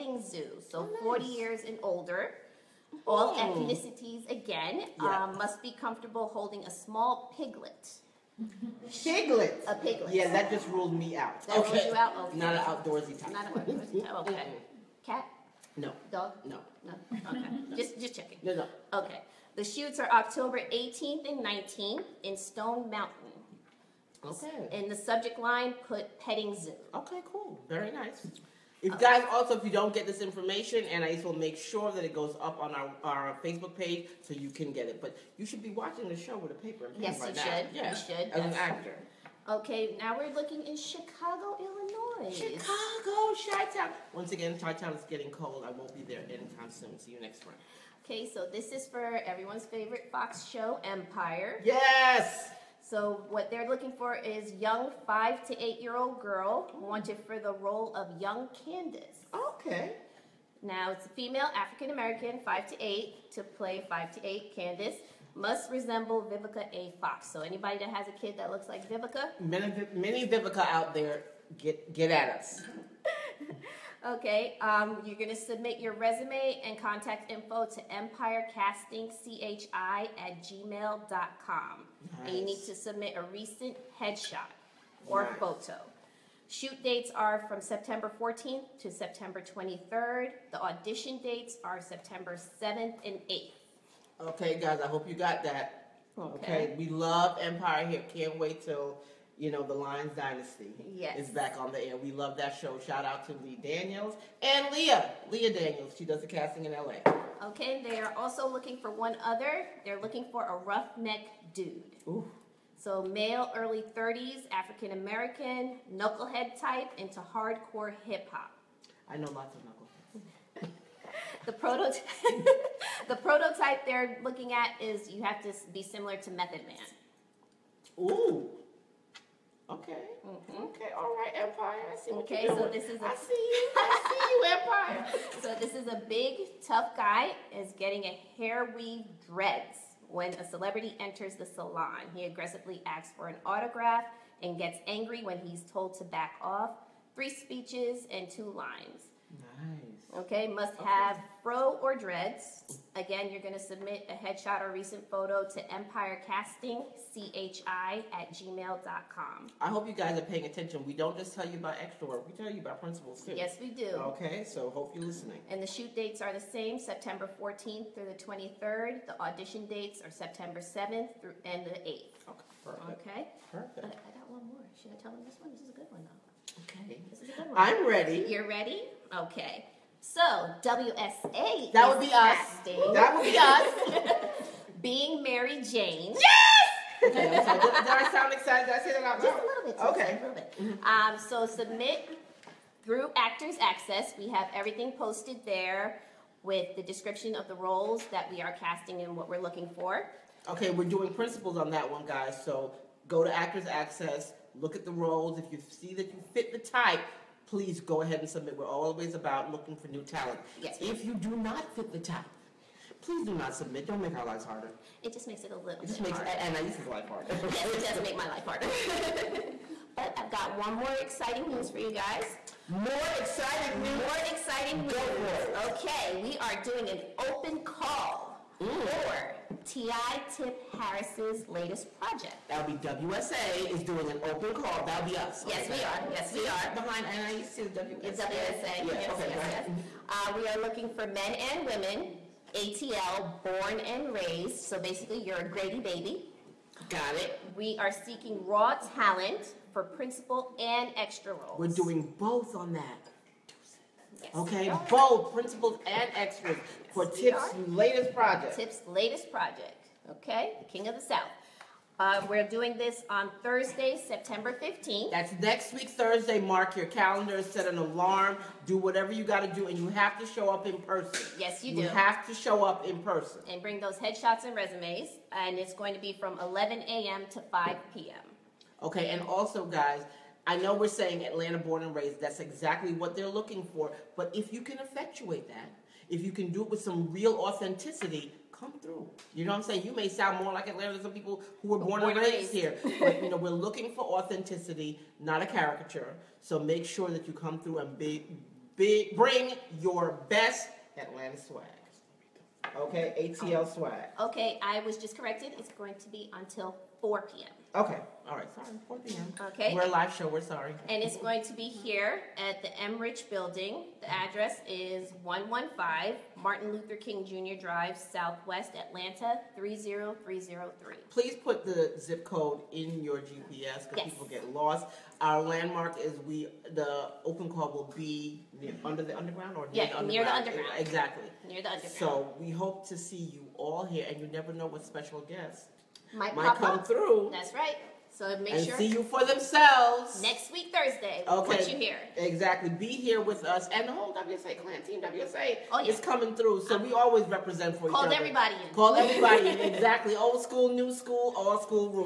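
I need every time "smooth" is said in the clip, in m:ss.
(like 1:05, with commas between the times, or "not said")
not said.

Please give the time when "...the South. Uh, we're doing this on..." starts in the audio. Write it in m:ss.
4:20.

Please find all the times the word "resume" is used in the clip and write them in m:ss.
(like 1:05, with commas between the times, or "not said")
1:15, 4:34.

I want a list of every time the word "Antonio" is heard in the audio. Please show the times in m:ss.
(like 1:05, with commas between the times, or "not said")
not said.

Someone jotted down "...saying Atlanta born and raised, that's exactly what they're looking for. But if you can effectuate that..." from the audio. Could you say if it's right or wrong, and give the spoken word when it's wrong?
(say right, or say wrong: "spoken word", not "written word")
right.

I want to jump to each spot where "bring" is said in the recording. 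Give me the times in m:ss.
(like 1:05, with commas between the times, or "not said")
4:33, 4:59.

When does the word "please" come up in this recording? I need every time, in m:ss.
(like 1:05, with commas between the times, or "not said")
3:27, 3:33, 5:21.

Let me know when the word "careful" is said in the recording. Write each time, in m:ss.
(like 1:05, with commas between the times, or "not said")
not said.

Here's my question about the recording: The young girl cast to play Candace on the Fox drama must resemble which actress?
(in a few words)
Vivica A. Fox.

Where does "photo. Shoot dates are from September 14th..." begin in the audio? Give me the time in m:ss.
1:25.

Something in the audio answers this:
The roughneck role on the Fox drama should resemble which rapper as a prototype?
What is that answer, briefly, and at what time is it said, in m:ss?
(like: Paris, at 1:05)
Method Man, at 2:06.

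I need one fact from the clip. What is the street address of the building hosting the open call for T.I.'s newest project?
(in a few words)
115 Martin Luther King Jr. Drive.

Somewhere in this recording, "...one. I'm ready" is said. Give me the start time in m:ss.
2:57.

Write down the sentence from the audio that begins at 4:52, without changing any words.
But you know, we're looking for authenticity, not a caricature.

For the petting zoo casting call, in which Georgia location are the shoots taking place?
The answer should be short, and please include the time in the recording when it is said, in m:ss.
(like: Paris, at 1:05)
Stone Mountain, at 0:22.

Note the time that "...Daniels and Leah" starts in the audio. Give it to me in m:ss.
1:43.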